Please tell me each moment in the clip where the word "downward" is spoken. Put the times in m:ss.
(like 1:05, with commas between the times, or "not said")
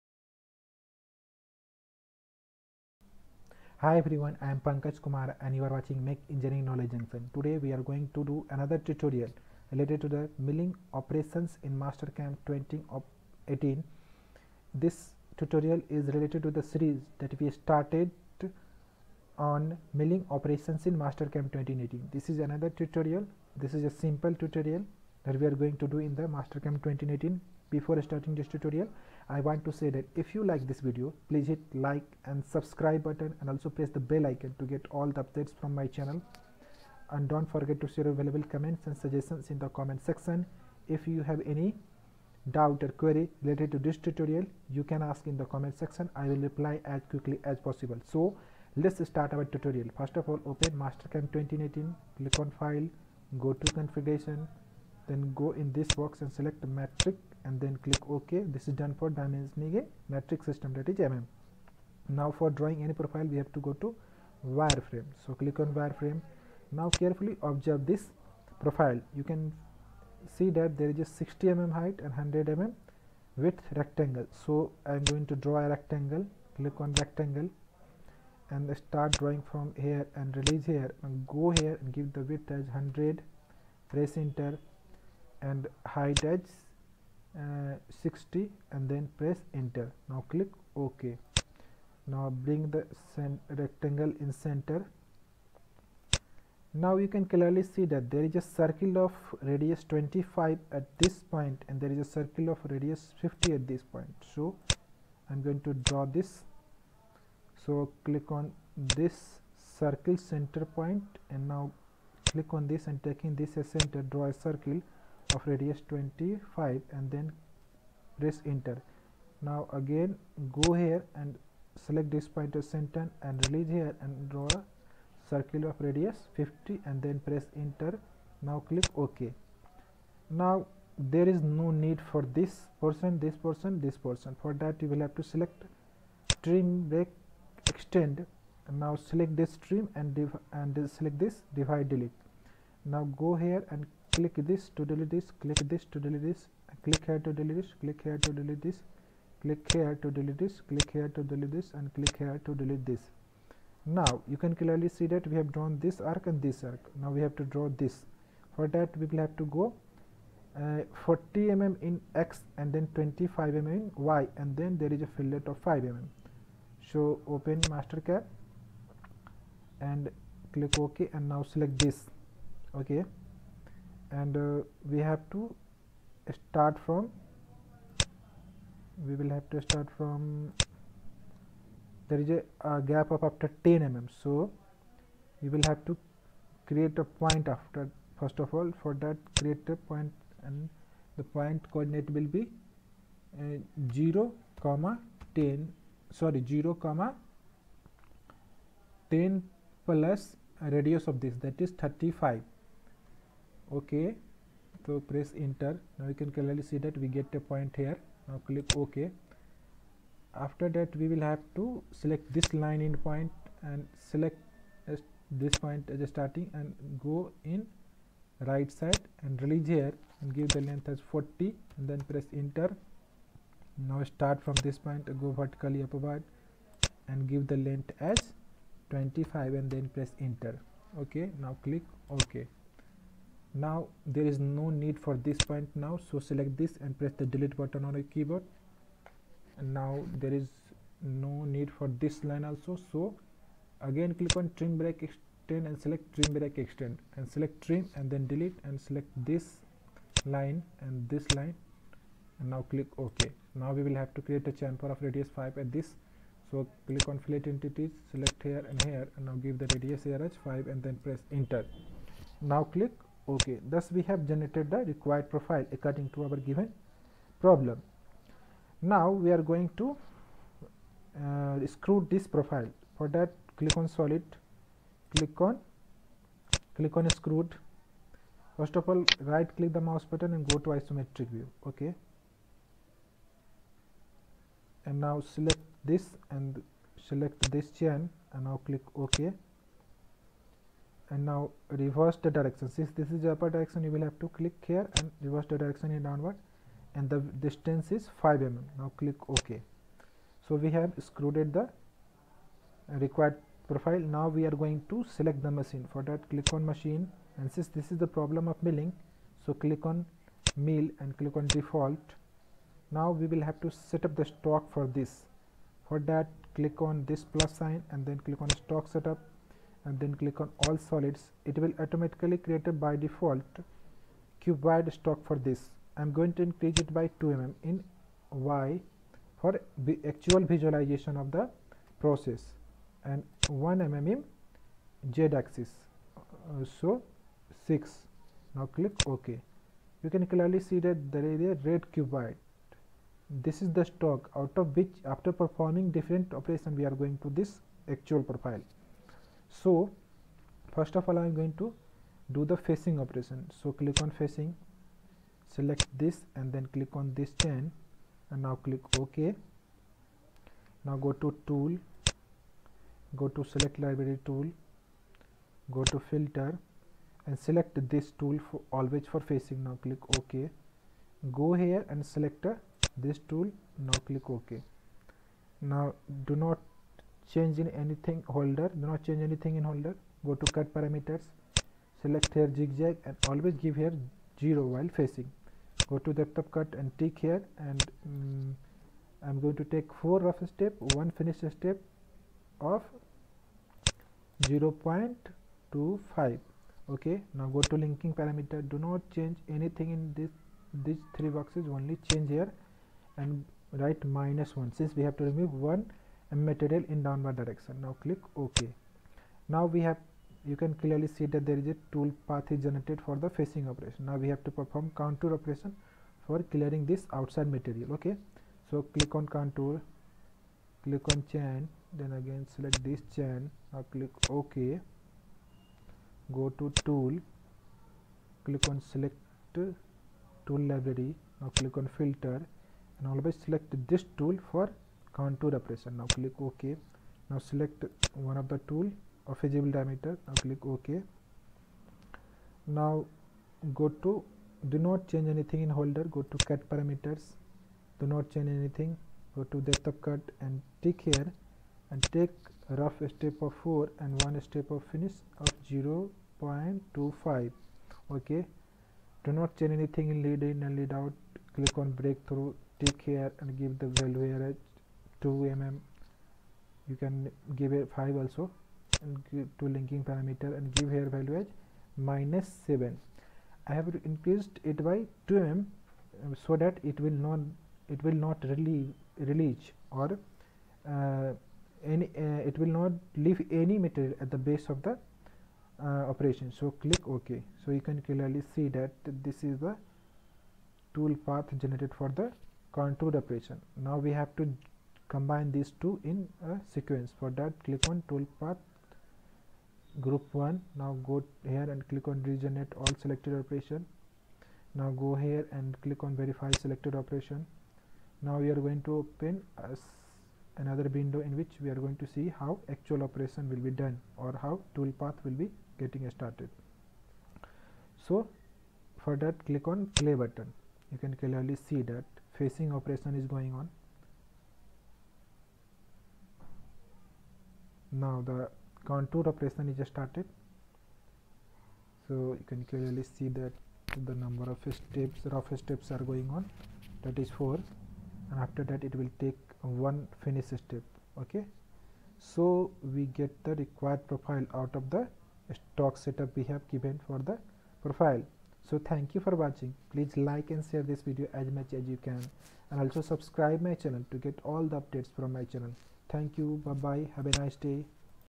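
4:56, 6:47.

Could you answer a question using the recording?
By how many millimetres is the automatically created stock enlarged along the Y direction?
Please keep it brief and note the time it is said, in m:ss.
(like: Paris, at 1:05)
2 mm, at 5:26.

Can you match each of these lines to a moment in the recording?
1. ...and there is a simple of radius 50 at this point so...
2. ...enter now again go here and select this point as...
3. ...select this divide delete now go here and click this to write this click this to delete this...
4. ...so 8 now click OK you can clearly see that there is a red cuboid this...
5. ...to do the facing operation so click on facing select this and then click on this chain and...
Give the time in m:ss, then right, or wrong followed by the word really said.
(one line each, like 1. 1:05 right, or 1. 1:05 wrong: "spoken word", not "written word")
1. 1:41 wrong: "circle", not "simple"
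2. 1:58 right
3. 2:20 wrong: "delete", not "write"
4. 5:36 wrong: "6", not "8"
5. 5:51 right.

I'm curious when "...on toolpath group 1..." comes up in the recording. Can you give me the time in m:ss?
8:17.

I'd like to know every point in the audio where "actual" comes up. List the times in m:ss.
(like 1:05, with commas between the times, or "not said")
5:30, 5:47, 8:32.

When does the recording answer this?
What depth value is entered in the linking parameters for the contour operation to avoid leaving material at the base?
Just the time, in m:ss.
7:50.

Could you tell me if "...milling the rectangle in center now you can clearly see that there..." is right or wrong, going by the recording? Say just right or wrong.
wrong.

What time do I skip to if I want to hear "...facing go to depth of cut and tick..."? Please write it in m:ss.
6:24.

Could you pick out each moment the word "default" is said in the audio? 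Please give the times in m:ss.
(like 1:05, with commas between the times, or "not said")
5:11, 5:23.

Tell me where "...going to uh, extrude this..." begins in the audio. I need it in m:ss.
4:29.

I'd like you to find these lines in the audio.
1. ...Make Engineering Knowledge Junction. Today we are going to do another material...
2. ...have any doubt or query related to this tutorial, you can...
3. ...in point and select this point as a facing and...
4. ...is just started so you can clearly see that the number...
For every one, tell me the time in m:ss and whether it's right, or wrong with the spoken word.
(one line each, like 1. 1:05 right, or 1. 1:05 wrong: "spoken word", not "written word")
1. 0:06 wrong: "tutorial", not "material"
2. 0:41 right
3. 3:32 wrong: "starting", not "facing"
4. 8:49 right.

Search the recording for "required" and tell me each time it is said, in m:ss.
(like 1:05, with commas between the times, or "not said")
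4:24, 5:03, 9:03.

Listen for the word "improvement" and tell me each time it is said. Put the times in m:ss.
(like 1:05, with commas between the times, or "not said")
not said.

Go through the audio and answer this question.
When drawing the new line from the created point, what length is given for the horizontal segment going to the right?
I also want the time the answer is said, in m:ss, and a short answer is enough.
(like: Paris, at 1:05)
40, at 3:40.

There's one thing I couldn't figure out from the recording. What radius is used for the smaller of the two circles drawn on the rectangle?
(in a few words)
25.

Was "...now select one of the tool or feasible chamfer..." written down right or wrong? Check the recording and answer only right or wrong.
wrong.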